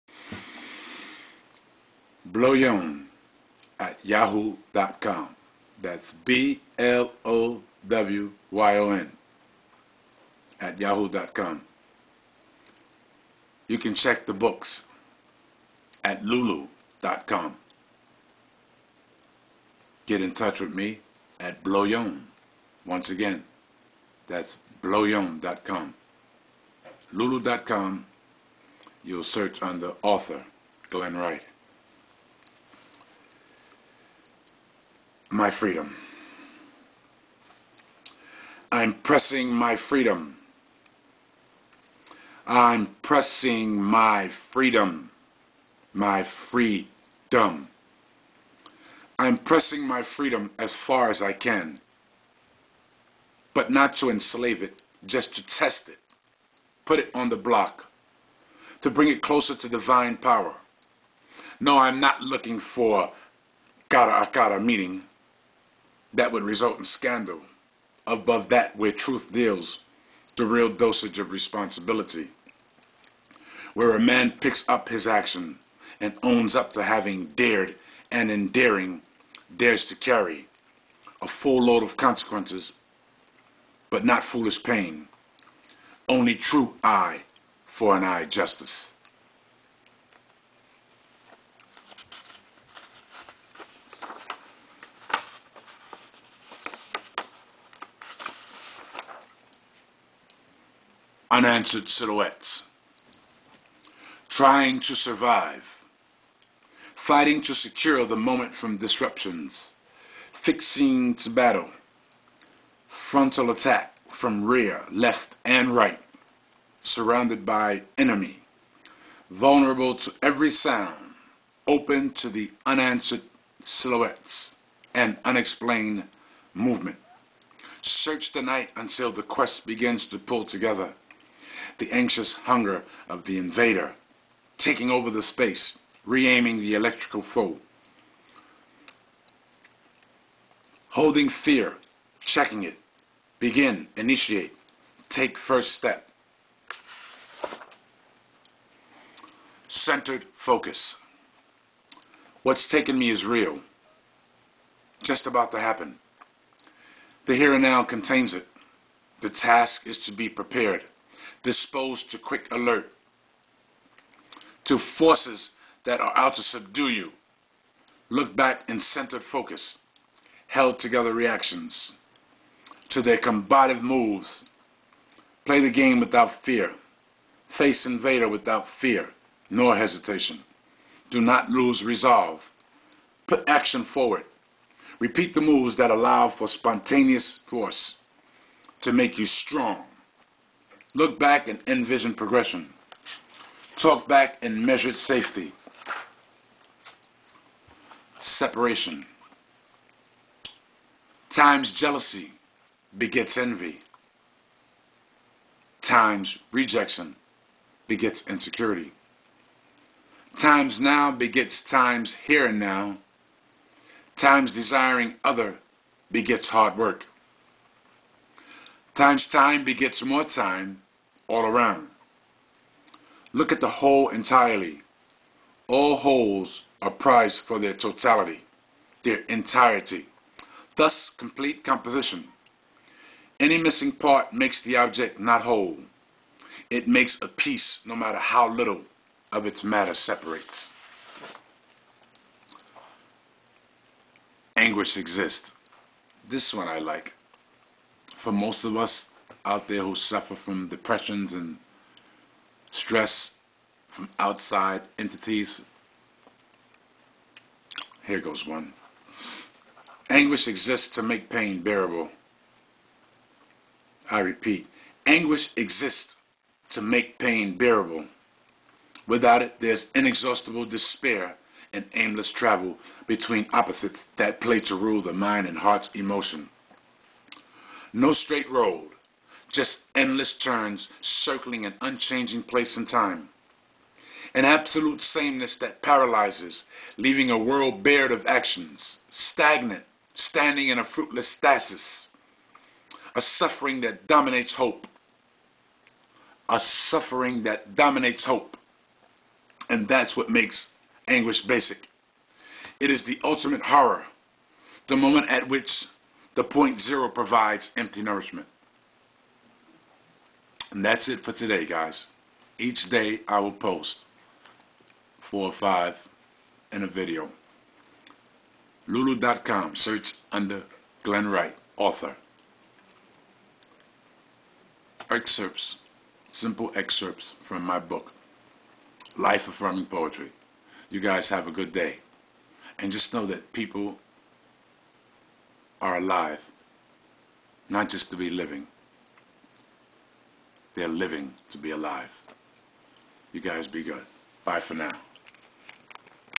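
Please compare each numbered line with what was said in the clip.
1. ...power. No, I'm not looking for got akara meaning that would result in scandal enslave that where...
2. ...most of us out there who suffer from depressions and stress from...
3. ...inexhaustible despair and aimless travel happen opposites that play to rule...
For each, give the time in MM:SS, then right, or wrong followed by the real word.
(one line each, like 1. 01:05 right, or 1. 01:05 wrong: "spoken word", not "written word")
1. 01:00 wrong: "above", not "enslave"
2. 04:08 right
3. 04:29 wrong: "between", not "happen".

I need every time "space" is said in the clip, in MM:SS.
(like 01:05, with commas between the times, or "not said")
02:15.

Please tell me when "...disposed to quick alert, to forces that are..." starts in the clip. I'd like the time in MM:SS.
02:41.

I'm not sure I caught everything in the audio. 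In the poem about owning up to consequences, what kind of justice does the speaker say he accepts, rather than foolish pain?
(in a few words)
eye for an eye.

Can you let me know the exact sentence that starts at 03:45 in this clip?
All wholes are prized for their totality, their entirety, thus complete composition.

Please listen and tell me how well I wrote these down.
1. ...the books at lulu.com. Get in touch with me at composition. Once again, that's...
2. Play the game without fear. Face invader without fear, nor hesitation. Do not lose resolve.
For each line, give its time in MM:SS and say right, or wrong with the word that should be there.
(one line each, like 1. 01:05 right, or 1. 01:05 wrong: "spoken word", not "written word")
1. 00:14 wrong: "blowyon", not "composition"
2. 02:55 right.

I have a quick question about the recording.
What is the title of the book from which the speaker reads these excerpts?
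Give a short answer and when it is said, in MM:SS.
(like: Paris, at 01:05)
Life Affirming Poetry, at 05:29.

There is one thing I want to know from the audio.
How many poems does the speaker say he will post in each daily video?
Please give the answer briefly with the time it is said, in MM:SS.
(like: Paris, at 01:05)
4 or 5, at 05:15.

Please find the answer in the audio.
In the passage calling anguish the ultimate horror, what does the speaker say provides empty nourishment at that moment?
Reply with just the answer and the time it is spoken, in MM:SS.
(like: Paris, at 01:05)
point zero, at 05:06.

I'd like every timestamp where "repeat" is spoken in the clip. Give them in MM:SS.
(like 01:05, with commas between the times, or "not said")
03:04, 04:24.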